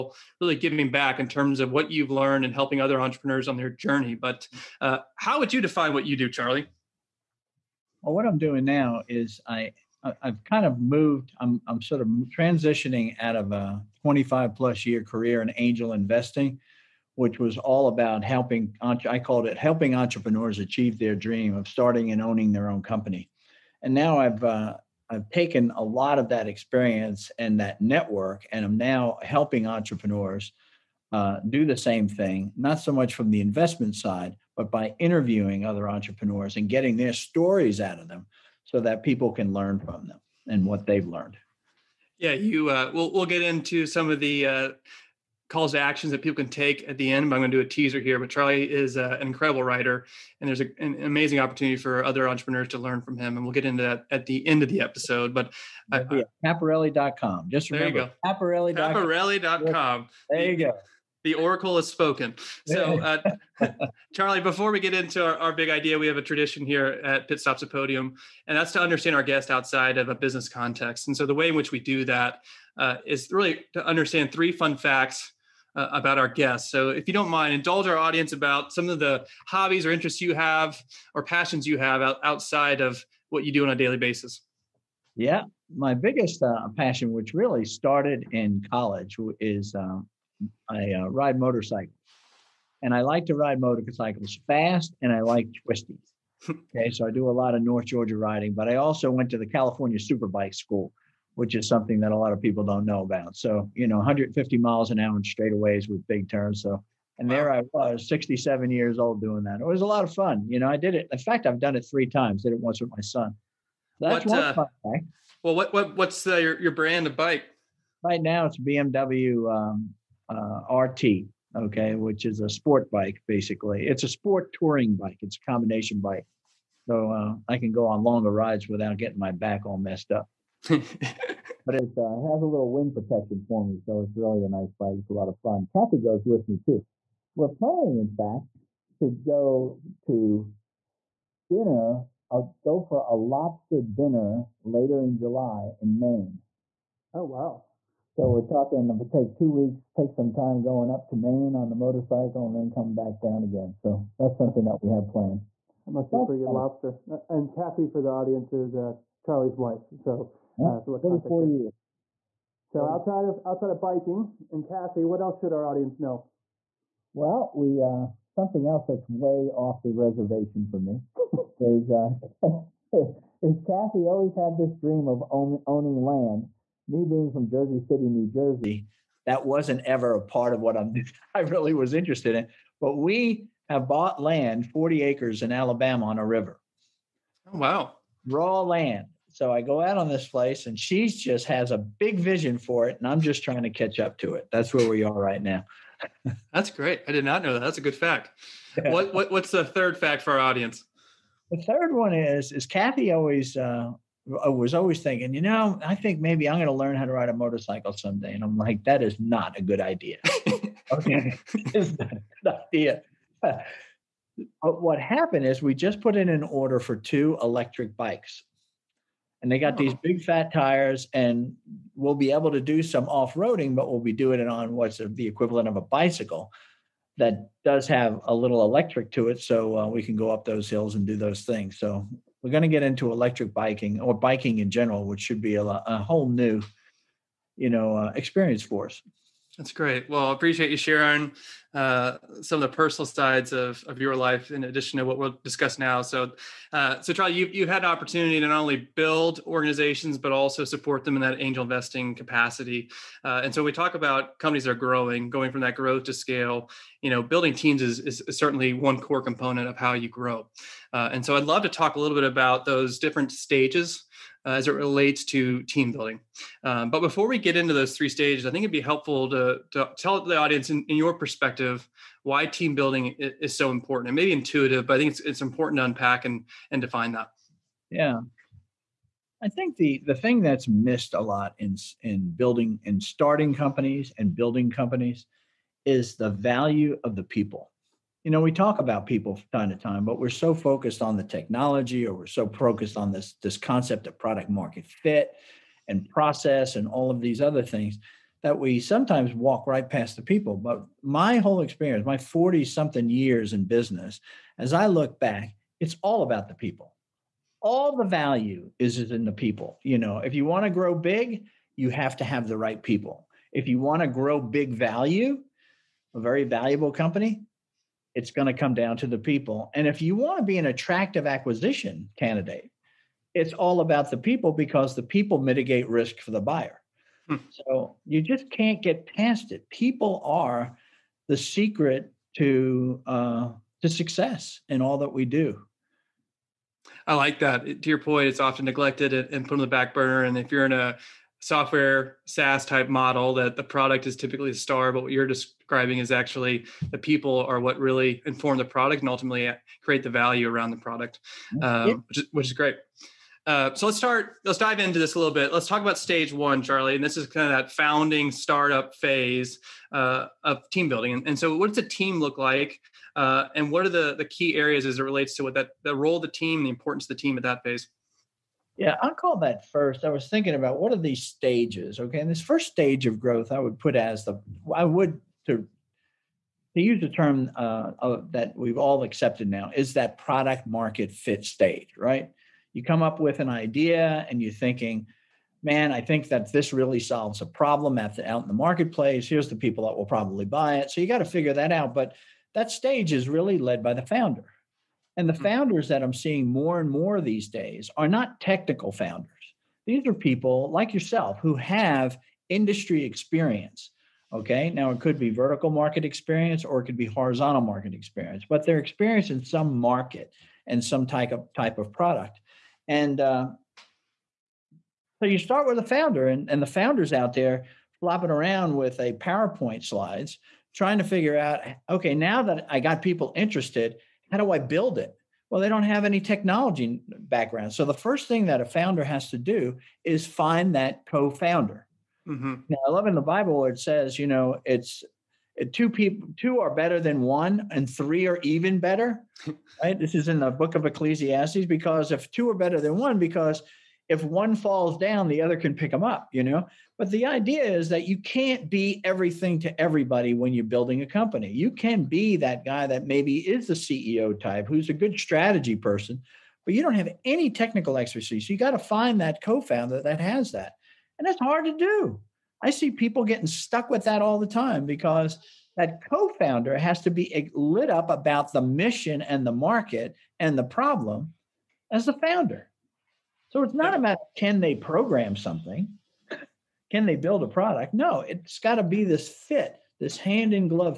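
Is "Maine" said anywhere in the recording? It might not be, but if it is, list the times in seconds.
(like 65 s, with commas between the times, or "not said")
145 s, 151 s.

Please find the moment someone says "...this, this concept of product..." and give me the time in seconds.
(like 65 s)
293 s.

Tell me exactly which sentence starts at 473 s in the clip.
So it's not about can they program something?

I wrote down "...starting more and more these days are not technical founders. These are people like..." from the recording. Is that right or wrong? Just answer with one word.
wrong.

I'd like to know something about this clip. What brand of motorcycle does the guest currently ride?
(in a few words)
BMW.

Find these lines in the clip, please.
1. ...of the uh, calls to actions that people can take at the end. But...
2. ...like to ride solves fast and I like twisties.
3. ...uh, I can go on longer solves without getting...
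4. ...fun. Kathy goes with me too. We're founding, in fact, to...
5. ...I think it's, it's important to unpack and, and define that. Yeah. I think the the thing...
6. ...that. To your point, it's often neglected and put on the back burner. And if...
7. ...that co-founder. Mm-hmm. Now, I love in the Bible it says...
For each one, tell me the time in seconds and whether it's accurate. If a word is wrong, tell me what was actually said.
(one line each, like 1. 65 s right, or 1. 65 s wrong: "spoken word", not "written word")
1. 44 s right
2. 93 s wrong: "motorcycles", not "solves"
3. 127 s wrong: "rides", not "solves"
4. 135 s wrong: "planning", not "founding"
5. 274 s right
6. 337 s right
7. 430 s right.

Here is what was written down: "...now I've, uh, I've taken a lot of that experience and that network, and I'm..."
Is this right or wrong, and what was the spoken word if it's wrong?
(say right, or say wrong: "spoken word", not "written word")
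right.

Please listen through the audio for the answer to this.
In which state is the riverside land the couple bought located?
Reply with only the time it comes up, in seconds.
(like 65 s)
185 s.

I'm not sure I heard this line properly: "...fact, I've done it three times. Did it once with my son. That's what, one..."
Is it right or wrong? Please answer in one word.
right.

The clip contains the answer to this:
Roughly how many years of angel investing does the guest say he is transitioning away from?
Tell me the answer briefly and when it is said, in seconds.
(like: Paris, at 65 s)
25, at 14 s.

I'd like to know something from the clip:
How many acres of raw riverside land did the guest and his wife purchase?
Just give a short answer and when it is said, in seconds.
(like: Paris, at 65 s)
40, at 184 s.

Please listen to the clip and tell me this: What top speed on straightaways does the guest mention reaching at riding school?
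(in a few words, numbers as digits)
150 miles an hour.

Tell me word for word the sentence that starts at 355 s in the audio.
Let's talk about stage one, Charlie.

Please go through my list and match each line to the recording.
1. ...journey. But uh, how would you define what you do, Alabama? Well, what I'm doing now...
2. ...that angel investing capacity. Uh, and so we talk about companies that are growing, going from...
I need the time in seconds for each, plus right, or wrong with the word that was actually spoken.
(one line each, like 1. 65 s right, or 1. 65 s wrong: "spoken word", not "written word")
1. 3 s wrong: "Charlie", not "Alabama"
2. 251 s right.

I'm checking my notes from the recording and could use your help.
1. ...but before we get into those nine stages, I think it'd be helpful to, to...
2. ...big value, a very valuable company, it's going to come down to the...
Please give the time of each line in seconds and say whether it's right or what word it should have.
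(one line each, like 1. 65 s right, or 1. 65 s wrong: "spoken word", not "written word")
1. 266 s wrong: "three", not "nine"
2. 314 s right.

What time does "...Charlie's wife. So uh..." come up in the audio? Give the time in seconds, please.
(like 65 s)
159 s.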